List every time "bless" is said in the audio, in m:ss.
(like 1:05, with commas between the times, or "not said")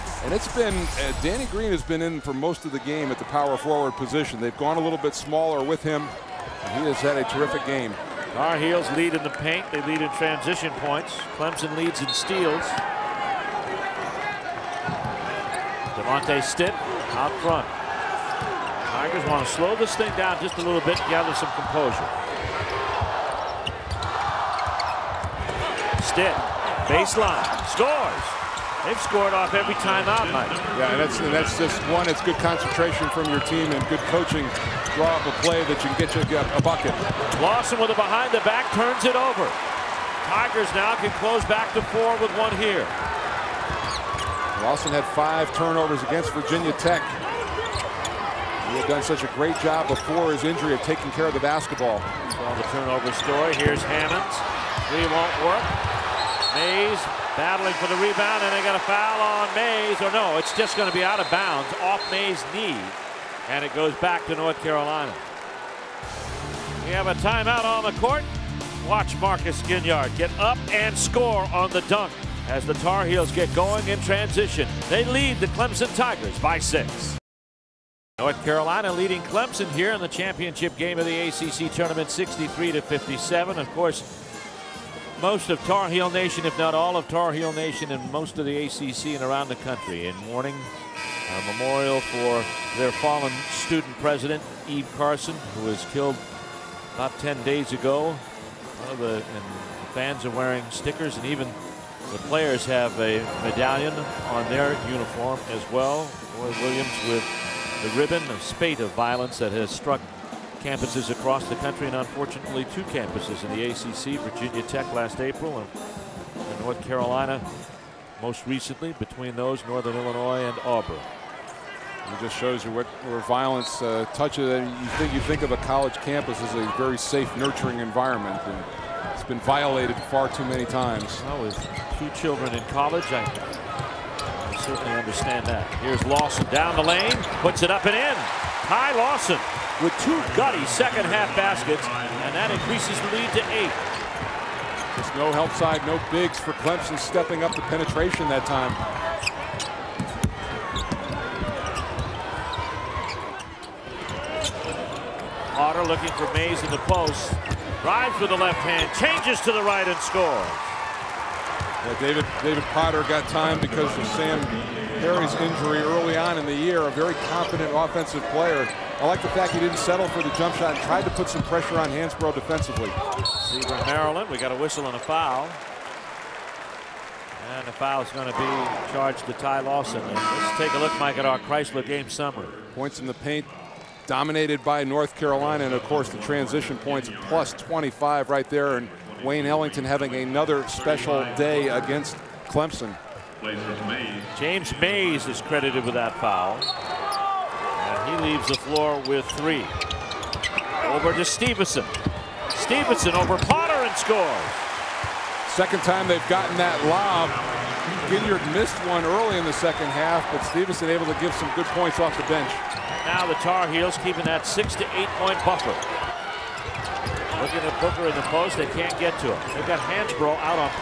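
not said.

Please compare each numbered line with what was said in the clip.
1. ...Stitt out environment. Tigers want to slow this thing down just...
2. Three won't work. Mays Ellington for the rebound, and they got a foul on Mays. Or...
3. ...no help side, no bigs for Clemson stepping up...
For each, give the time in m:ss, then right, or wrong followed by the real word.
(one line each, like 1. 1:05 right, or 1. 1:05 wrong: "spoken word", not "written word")
1. 0:16 wrong: "front", not "environment"
2. 0:54 wrong: "Battling", not "Ellington"
3. 2:25 right.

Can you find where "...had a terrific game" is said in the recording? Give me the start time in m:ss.
0:07.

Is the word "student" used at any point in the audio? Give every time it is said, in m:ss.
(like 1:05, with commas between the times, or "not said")
1:33.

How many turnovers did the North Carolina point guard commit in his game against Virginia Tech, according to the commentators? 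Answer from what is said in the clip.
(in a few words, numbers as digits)
5.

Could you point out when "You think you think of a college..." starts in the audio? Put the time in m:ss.
2:04.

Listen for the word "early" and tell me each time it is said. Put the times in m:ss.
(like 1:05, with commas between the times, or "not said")
2:45, 3:29.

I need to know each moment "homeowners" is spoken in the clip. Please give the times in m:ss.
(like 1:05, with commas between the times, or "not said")
not said.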